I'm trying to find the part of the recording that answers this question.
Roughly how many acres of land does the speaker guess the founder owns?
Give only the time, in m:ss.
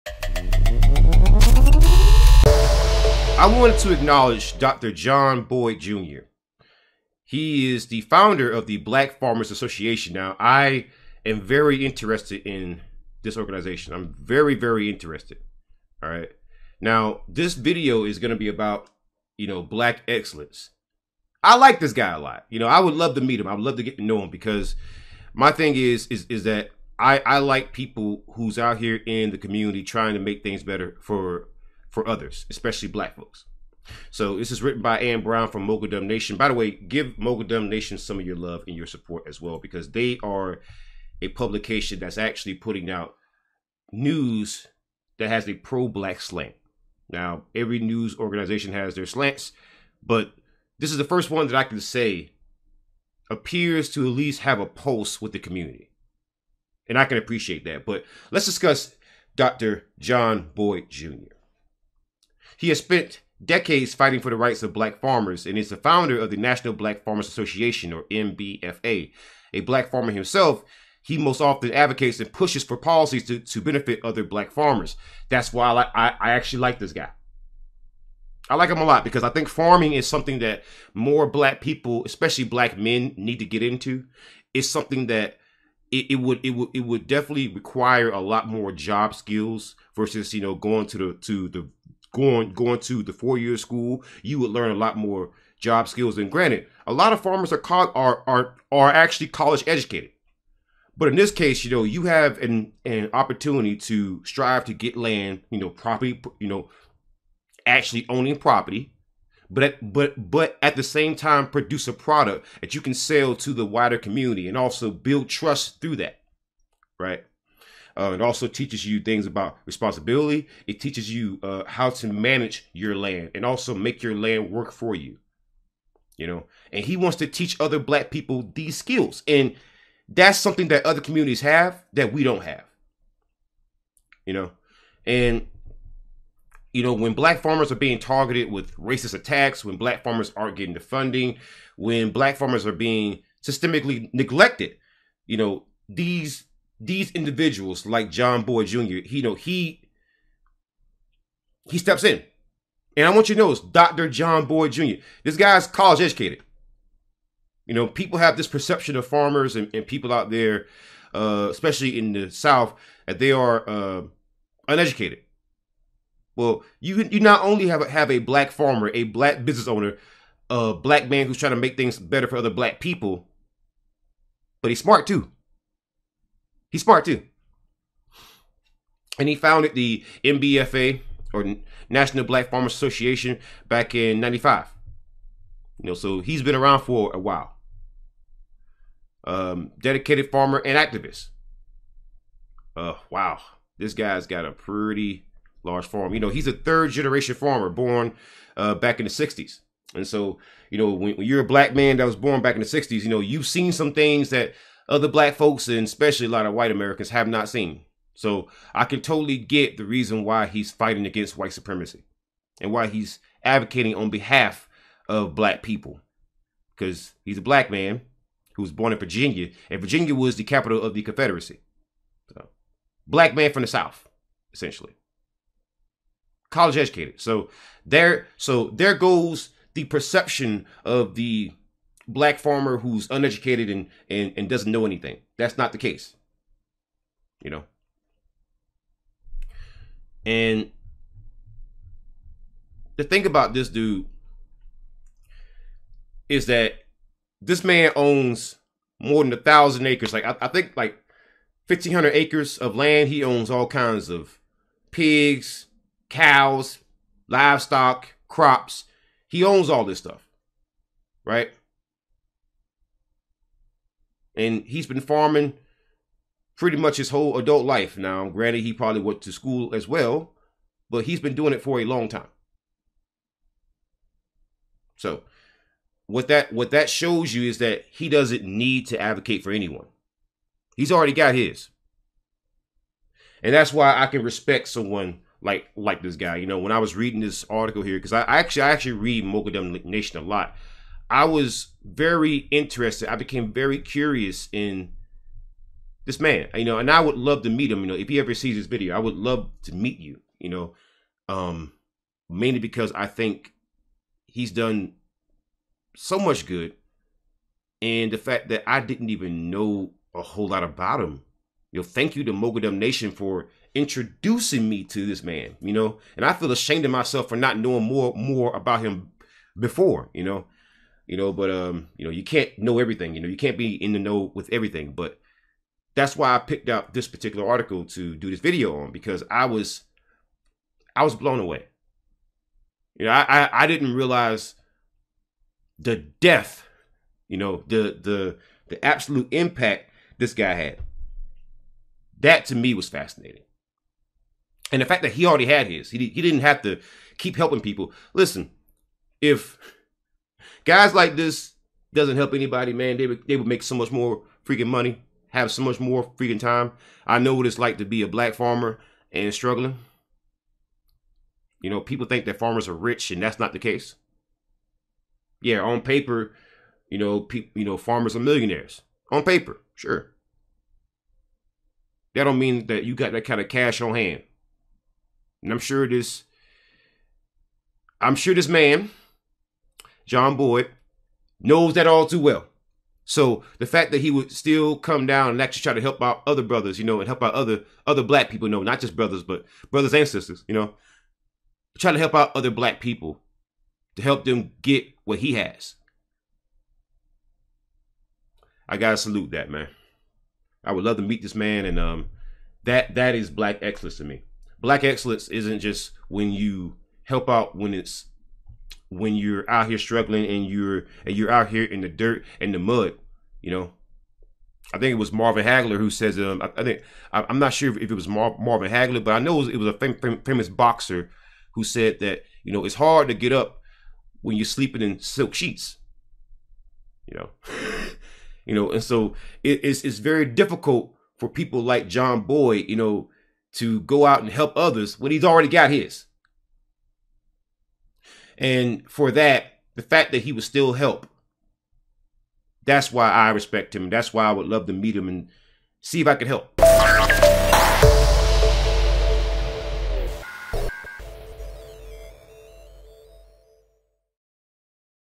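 4:11.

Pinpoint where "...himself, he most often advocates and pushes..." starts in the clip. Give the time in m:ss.
1:10.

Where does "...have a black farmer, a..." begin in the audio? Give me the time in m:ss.
2:47.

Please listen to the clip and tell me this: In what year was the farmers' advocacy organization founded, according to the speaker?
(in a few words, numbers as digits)
1995.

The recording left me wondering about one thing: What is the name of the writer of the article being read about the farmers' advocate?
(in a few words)
Ann Brown.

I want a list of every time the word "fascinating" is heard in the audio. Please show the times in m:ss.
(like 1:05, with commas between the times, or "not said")
5:42.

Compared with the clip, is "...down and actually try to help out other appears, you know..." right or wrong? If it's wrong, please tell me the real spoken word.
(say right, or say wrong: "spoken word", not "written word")
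wrong: "brothers", not "appears".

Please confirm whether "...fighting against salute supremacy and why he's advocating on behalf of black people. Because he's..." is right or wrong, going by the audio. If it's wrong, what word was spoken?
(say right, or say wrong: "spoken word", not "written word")
wrong: "white", not "salute".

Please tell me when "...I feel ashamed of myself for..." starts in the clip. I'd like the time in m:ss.
5:16.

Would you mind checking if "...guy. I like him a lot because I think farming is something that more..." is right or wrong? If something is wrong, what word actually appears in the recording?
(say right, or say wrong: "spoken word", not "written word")
right.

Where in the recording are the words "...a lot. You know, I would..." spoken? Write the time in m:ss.
0:22.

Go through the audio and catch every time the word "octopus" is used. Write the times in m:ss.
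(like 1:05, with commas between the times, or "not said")
not said.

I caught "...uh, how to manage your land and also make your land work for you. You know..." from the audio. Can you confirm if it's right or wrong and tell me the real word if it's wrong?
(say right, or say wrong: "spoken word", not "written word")
right.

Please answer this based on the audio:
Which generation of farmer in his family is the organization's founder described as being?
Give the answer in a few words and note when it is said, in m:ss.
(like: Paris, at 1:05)
Third generation, at 3:16.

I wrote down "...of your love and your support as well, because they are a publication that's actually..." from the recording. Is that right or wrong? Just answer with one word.
right.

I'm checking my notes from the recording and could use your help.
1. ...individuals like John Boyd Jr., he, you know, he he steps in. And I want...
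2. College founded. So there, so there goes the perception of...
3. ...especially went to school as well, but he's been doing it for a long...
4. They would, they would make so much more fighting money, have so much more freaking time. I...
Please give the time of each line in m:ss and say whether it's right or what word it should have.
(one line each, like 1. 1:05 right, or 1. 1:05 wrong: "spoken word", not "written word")
1. 2:27 right
2. 3:46 wrong: "educated", not "founded"
3. 4:28 wrong: "probably", not "especially"
4. 5:52 wrong: "freaking", not "fighting".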